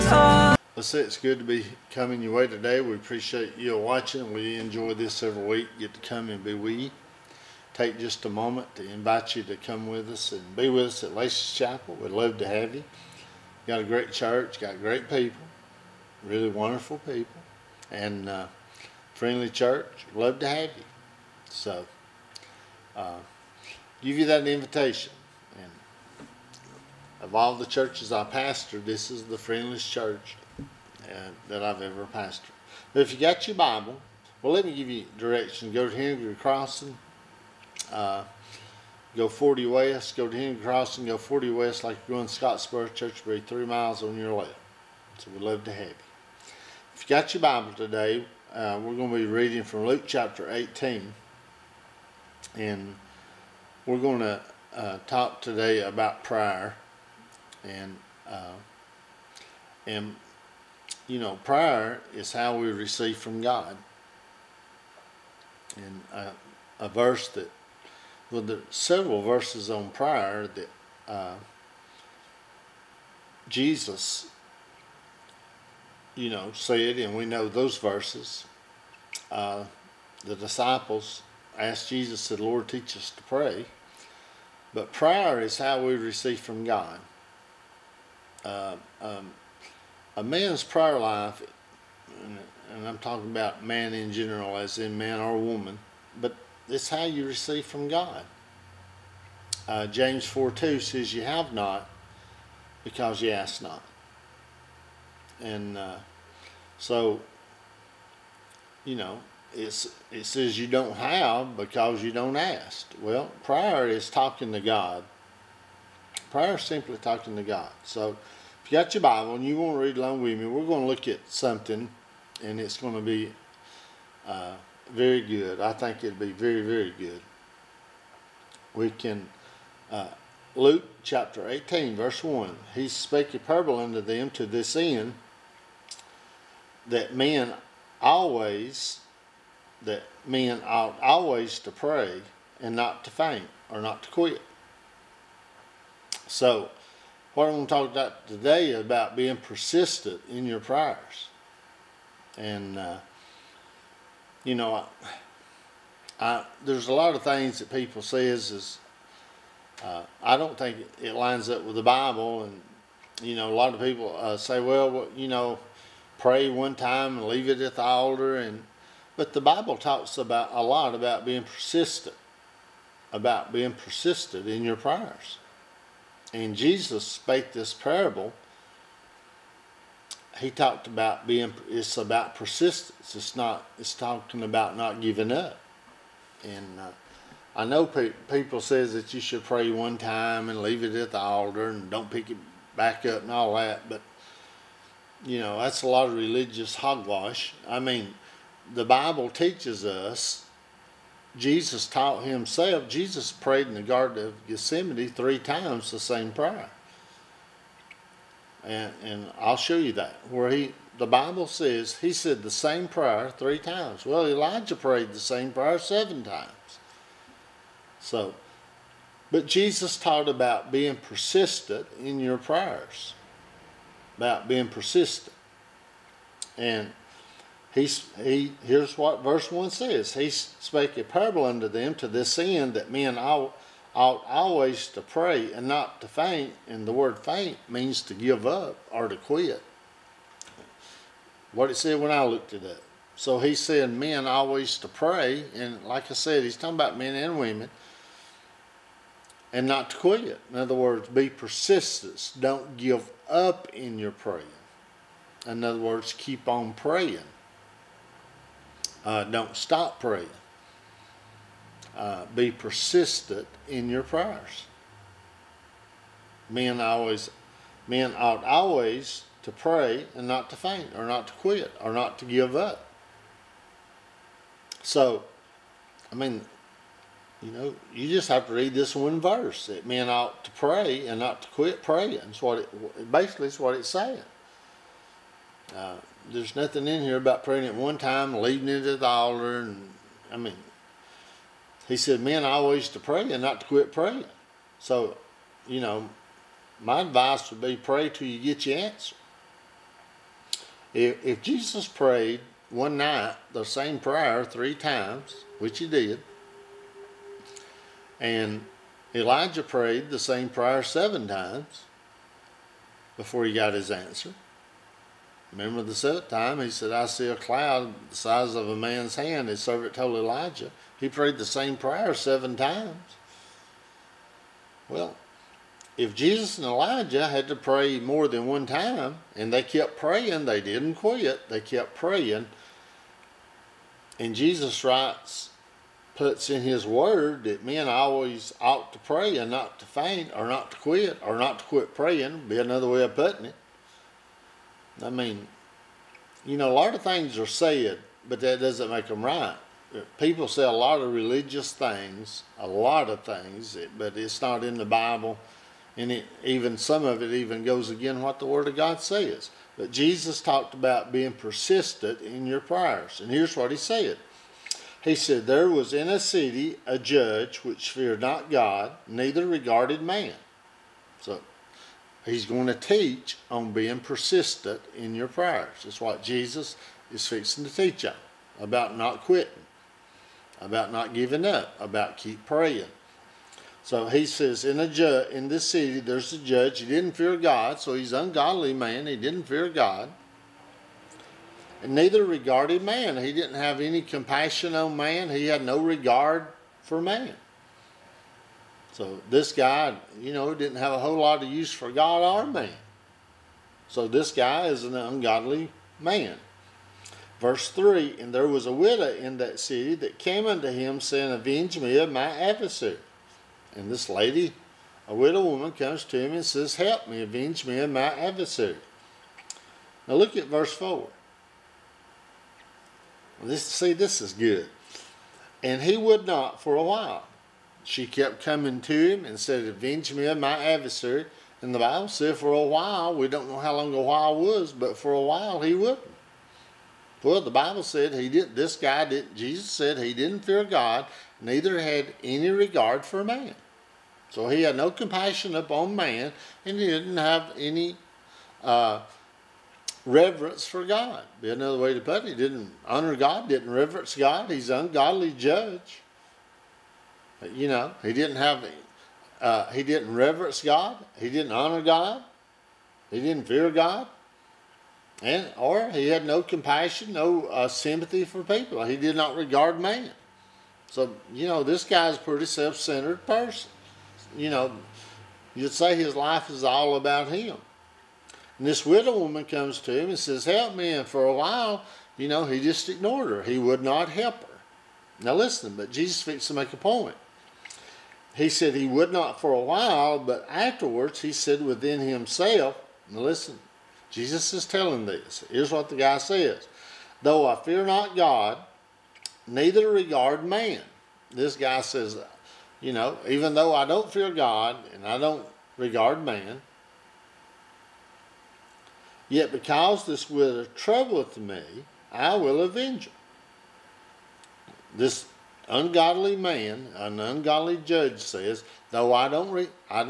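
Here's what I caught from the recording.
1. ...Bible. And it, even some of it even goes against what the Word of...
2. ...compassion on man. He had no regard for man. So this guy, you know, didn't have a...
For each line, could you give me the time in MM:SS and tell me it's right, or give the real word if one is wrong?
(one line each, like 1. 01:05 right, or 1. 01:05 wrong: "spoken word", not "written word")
1. 05:54 right
2. 06:34 right.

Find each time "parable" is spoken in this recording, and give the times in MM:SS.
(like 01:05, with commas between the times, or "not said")
02:13, 02:57, 03:51.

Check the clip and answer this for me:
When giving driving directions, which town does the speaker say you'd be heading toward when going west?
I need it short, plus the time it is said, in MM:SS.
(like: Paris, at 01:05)
Scottsboro, at 00:42.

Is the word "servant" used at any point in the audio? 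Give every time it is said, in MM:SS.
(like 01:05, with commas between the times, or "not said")
05:19.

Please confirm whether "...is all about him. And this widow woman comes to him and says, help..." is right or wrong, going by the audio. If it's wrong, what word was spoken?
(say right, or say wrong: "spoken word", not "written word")
right.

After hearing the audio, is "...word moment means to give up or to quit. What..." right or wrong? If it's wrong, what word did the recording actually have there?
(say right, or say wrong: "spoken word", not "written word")
wrong: "faint", not "moment".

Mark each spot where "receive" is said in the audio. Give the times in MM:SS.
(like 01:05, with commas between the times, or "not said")
01:02, 01:25, 01:37.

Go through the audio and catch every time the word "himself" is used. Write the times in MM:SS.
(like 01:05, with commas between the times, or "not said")
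03:22, 08:11.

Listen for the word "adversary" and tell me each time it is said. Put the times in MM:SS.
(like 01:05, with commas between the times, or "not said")
06:52, 06:58, 07:10.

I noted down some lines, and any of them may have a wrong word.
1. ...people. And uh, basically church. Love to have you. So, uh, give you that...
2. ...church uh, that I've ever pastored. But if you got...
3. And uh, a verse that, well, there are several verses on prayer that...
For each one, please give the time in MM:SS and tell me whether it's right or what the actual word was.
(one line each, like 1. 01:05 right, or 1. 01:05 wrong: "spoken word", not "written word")
1. 00:16 wrong: "friendly", not "basically"
2. 00:29 right
3. 01:05 right.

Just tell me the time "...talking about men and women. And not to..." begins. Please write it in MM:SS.
04:06.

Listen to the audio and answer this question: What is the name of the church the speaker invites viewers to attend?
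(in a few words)
Lacey's Chapel.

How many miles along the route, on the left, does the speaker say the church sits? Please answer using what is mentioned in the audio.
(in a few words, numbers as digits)
3.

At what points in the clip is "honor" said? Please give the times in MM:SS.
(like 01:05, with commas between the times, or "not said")
07:32, 07:41.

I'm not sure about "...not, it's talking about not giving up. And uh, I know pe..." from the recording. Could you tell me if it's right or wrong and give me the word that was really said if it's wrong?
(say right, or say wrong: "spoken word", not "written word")
right.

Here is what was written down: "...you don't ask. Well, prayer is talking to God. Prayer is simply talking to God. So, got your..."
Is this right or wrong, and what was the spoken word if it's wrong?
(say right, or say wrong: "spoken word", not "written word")
right.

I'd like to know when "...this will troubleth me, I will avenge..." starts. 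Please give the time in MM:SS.
08:30.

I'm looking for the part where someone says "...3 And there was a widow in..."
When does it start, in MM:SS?
06:47.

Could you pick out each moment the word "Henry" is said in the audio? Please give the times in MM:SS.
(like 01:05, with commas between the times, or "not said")
00:35, 00:40.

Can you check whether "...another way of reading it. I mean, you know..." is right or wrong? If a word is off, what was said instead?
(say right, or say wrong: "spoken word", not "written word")
wrong: "putting", not "reading".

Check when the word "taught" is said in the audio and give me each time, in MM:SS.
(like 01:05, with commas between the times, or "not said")
03:21, 03:39.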